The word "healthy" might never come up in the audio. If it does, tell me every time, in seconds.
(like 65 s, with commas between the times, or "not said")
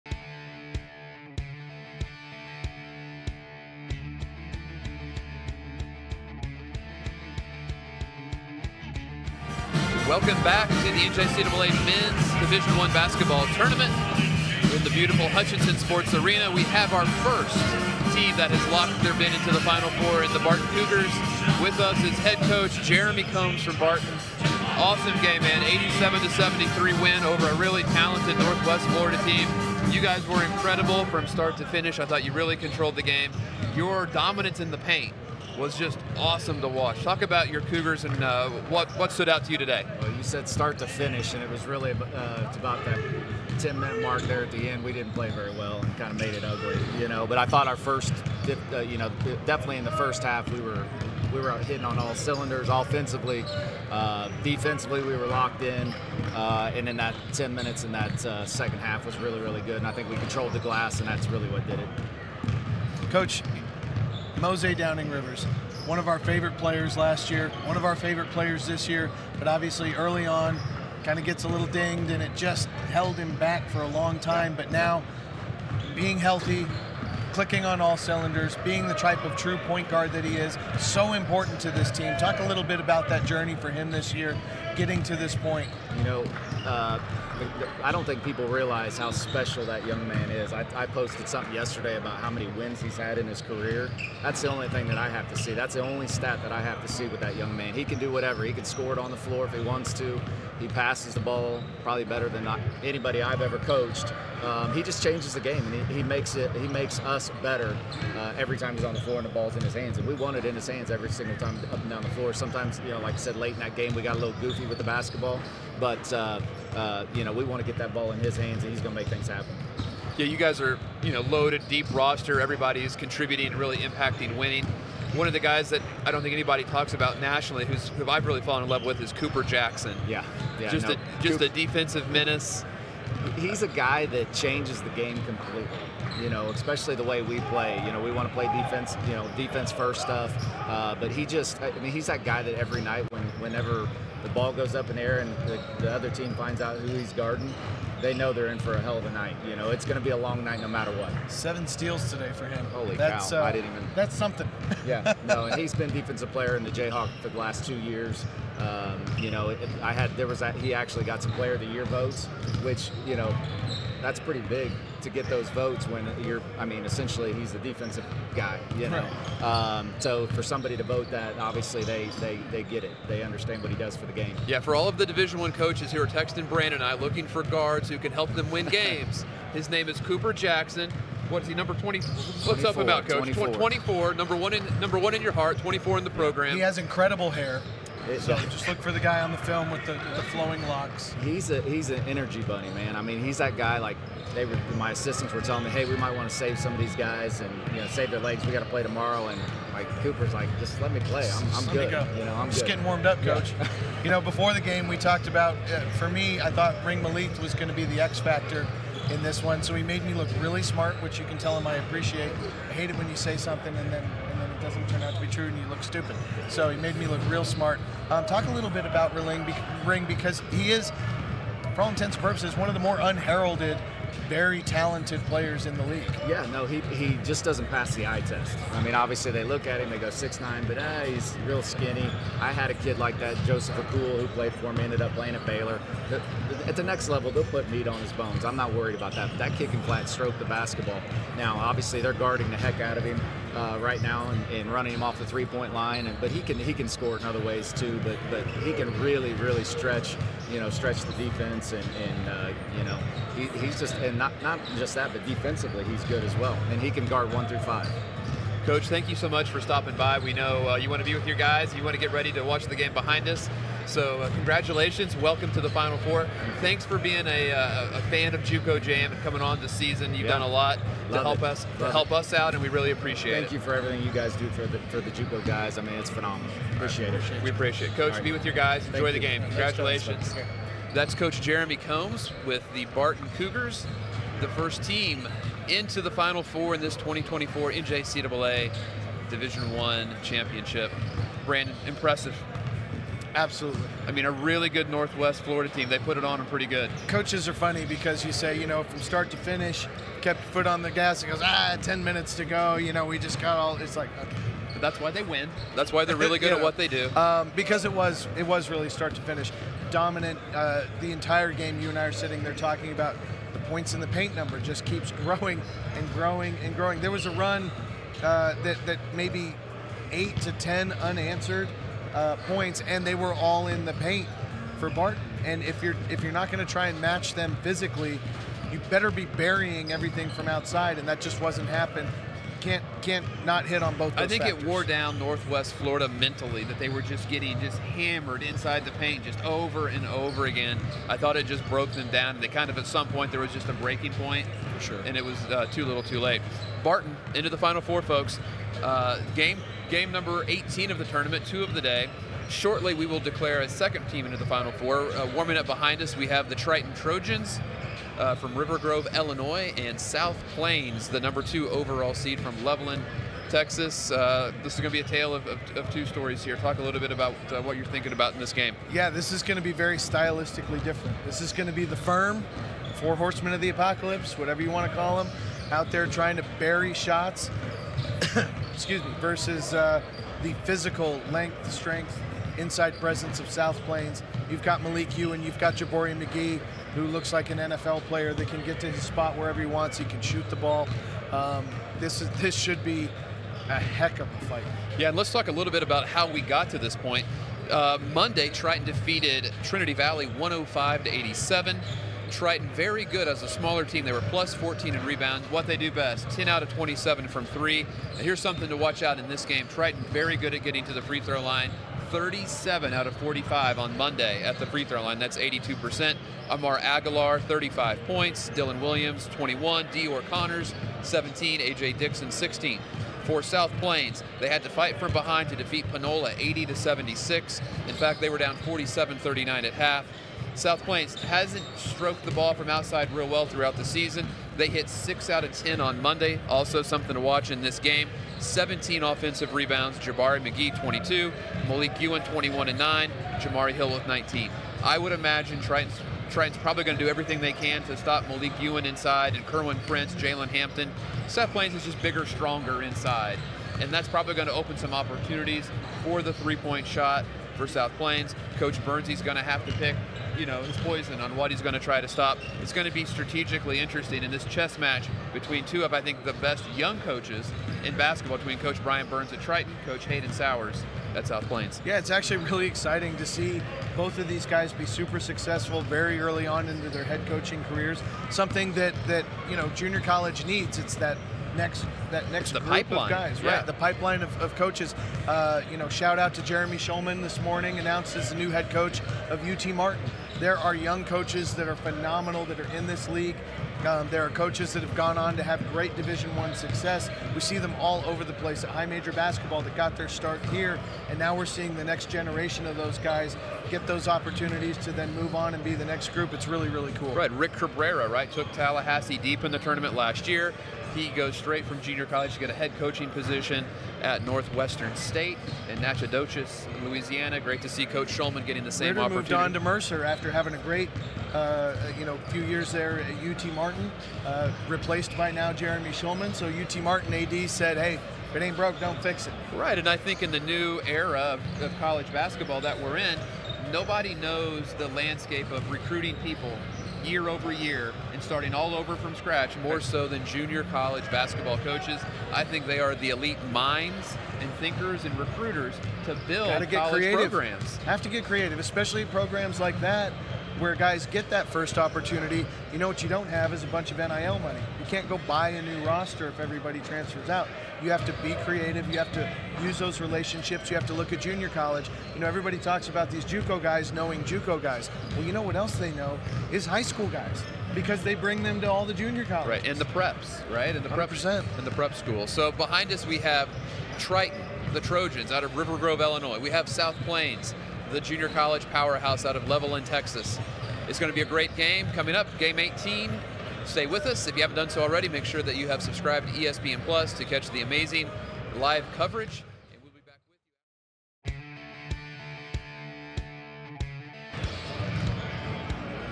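76 s.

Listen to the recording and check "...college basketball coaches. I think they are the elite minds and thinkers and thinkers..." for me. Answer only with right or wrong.
wrong.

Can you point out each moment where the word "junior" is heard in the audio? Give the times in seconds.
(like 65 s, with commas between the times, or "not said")
479 s, 511 s, 540 s, 561 s, 568 s, 578 s.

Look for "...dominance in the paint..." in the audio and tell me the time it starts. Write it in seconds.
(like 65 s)
34 s.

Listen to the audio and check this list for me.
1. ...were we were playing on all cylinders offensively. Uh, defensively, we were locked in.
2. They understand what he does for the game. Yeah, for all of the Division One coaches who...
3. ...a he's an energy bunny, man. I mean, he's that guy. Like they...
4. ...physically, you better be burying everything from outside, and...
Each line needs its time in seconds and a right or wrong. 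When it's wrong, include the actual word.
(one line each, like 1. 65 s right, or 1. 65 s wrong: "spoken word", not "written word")
1. 50 s wrong: "hitting", not "playing"
2. 173 s right
3. 191 s right
4. 327 s right.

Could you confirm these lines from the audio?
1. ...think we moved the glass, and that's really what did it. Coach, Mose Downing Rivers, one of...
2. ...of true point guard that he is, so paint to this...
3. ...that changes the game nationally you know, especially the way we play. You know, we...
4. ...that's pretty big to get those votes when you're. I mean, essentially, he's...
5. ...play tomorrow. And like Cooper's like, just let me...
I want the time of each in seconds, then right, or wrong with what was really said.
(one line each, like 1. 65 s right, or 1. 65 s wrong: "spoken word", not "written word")
1. 59 s wrong: "controlled", not "moved"
2. 79 s wrong: "important", not "paint"
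3. 134 s wrong: "completely", not "nationally"
4. 164 s right
5. 198 s right.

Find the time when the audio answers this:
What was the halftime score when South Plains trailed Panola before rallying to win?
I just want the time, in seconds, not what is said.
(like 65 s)
428 s.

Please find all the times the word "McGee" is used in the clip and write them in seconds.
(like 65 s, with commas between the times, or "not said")
386 s, 440 s.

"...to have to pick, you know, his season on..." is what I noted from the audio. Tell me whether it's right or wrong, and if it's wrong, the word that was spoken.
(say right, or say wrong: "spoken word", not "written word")
wrong: "poison", not "season".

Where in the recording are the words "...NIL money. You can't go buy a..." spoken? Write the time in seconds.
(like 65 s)
553 s.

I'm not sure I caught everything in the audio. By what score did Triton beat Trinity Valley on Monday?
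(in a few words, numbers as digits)
105 to 87.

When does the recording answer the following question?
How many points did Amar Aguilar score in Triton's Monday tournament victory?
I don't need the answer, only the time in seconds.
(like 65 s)
417 s.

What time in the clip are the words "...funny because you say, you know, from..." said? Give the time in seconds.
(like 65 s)
297 s.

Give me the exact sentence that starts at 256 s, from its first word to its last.
And he can guard one through five.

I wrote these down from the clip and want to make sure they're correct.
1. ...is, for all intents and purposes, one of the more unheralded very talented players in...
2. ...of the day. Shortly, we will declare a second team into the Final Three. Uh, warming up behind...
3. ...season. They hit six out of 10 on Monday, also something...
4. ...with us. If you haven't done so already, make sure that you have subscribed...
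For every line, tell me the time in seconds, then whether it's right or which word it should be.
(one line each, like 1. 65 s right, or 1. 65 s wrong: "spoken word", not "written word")
1. 220 s right
2. 351 s wrong: "Four", not "Three"
3. 433 s right
4. 583 s right.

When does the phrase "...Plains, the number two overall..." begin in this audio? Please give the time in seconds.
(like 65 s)
360 s.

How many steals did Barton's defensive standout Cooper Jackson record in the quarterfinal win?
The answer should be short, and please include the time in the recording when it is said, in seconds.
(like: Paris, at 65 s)
7, at 151 s.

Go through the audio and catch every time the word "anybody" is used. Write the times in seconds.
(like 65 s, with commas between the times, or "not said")
102 s, 126 s.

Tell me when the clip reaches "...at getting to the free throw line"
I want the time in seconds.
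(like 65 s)
410 s.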